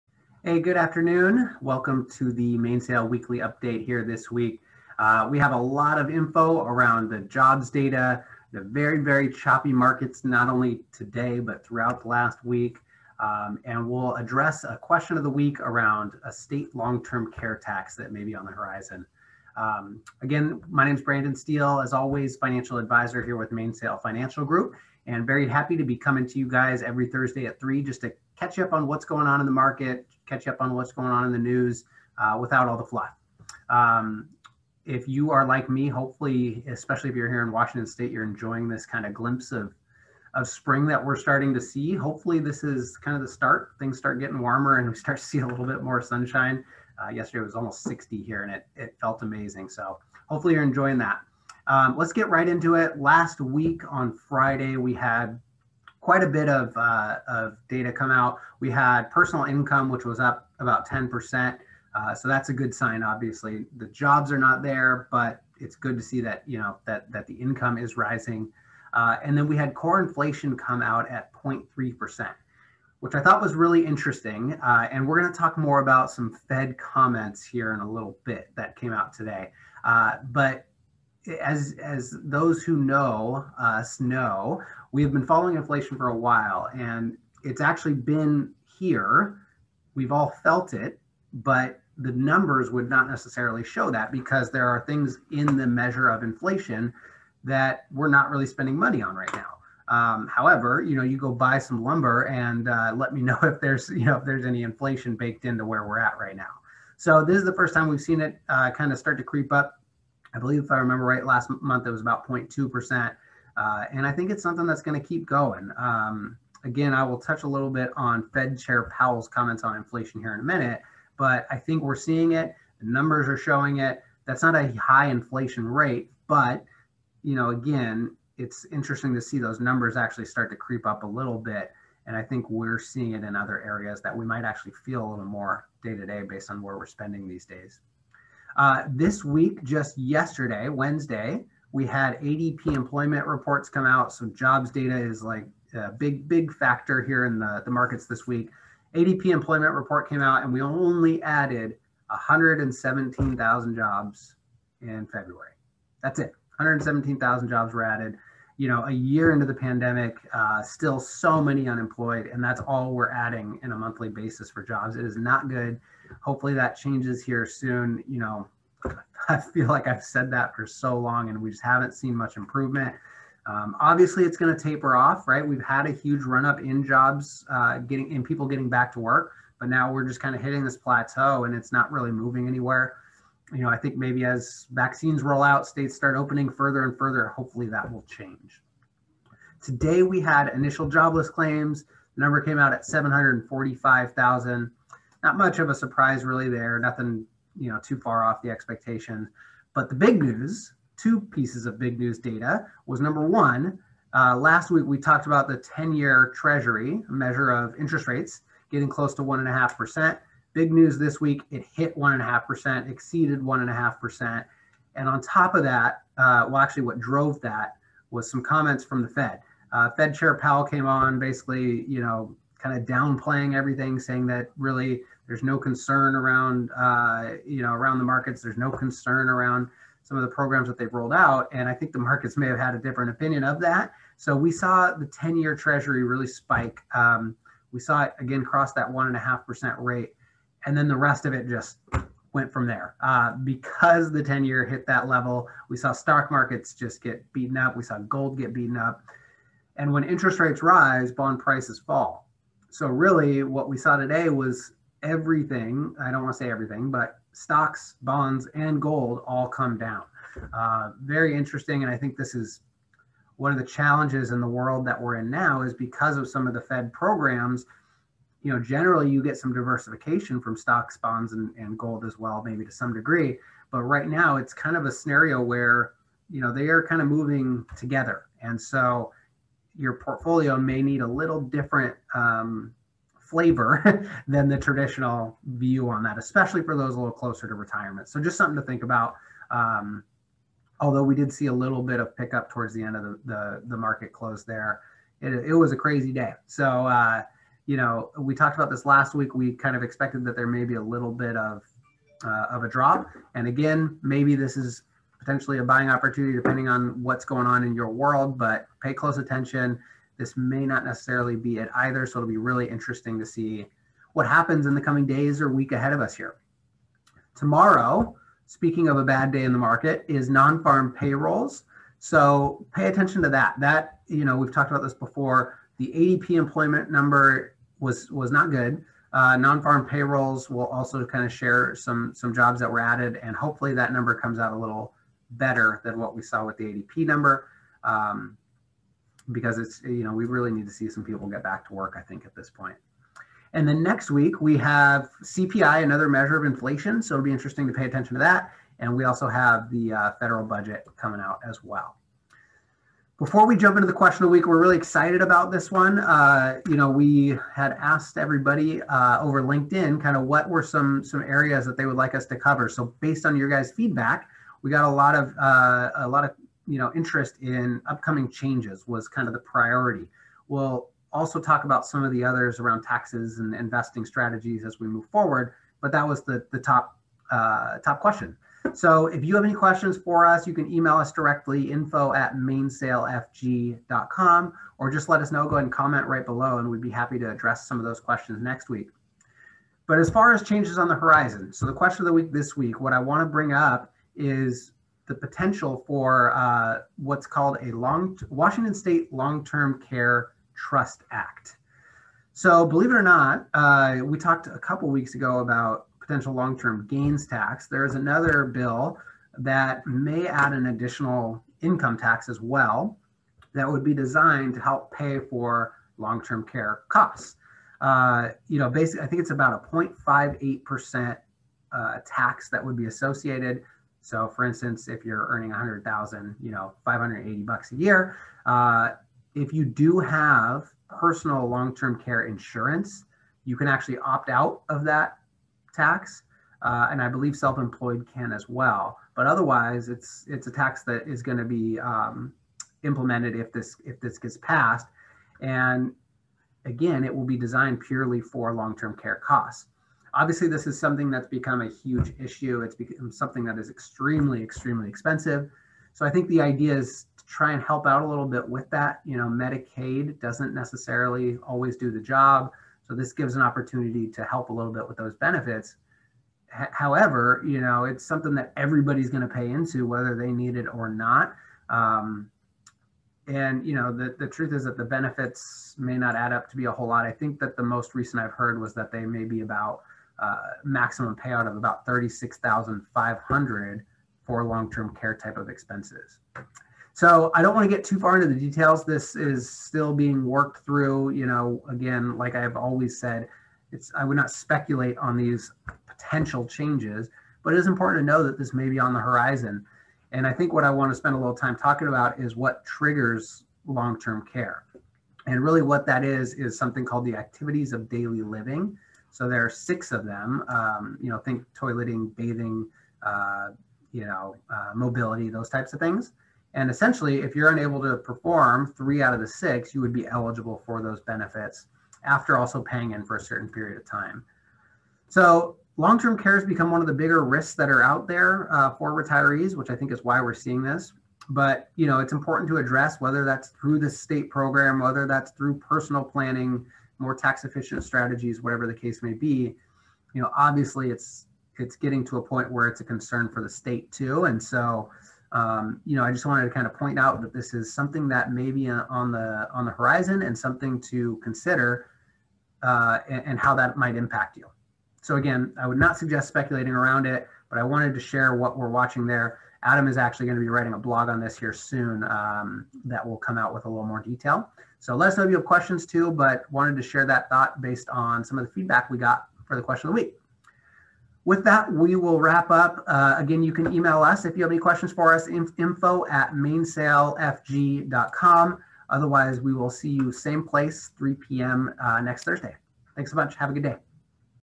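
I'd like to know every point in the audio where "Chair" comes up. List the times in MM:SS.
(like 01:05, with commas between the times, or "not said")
01:58, 03:40.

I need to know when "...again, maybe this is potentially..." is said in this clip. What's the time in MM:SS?
05:03.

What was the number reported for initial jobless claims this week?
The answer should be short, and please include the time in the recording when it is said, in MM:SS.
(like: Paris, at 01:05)
745,000, at 03:12.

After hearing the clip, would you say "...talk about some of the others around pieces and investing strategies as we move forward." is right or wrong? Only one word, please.
wrong.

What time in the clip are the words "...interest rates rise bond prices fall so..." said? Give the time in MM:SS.
04:10.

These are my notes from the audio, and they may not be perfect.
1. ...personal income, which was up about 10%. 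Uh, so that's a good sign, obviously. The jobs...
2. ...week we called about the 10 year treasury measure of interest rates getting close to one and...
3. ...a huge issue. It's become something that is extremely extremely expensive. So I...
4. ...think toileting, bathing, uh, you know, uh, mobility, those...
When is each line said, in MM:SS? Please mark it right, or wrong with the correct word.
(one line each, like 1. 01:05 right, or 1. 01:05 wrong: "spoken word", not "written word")
1. 00:59 right
2. 03:24 wrong: "talked", not "called"
3. 07:31 right
4. 08:31 right.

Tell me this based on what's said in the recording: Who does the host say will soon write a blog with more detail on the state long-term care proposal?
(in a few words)
Adam.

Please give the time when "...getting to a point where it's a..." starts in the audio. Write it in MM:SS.
09:01.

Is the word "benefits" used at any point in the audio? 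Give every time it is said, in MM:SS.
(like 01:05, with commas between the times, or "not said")
07:45, 07:54, 08:41.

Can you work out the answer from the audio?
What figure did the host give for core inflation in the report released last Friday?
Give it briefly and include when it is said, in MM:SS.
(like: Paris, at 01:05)
0.3%, at 01:11.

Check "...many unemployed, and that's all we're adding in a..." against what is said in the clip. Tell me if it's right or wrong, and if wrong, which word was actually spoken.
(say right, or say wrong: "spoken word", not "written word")
right.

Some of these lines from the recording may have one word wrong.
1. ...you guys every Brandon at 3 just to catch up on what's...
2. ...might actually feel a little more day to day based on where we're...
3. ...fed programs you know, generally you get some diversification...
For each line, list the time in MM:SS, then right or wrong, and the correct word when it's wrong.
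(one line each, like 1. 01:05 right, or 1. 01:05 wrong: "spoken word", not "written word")
1. 00:26 wrong: "Thursday", not "Brandon"
2. 02:14 right
3. 04:26 right.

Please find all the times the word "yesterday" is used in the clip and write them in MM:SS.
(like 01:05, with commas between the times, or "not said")
00:47, 02:19.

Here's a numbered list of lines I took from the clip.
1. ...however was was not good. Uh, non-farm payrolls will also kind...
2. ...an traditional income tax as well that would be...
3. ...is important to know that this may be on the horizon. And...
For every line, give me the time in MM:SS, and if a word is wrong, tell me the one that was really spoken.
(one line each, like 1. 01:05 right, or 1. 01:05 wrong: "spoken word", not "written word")
1. 05:26 wrong: "number", not "however"
2. 06:50 wrong: "additional", not "traditional"
3. 08:17 right.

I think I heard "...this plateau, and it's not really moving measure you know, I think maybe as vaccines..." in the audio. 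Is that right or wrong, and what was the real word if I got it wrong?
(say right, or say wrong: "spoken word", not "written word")
wrong: "anywhere", not "measure".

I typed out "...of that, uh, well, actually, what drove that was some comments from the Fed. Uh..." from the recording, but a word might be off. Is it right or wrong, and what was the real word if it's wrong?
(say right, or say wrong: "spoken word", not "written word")
right.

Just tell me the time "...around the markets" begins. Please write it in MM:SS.
03:47.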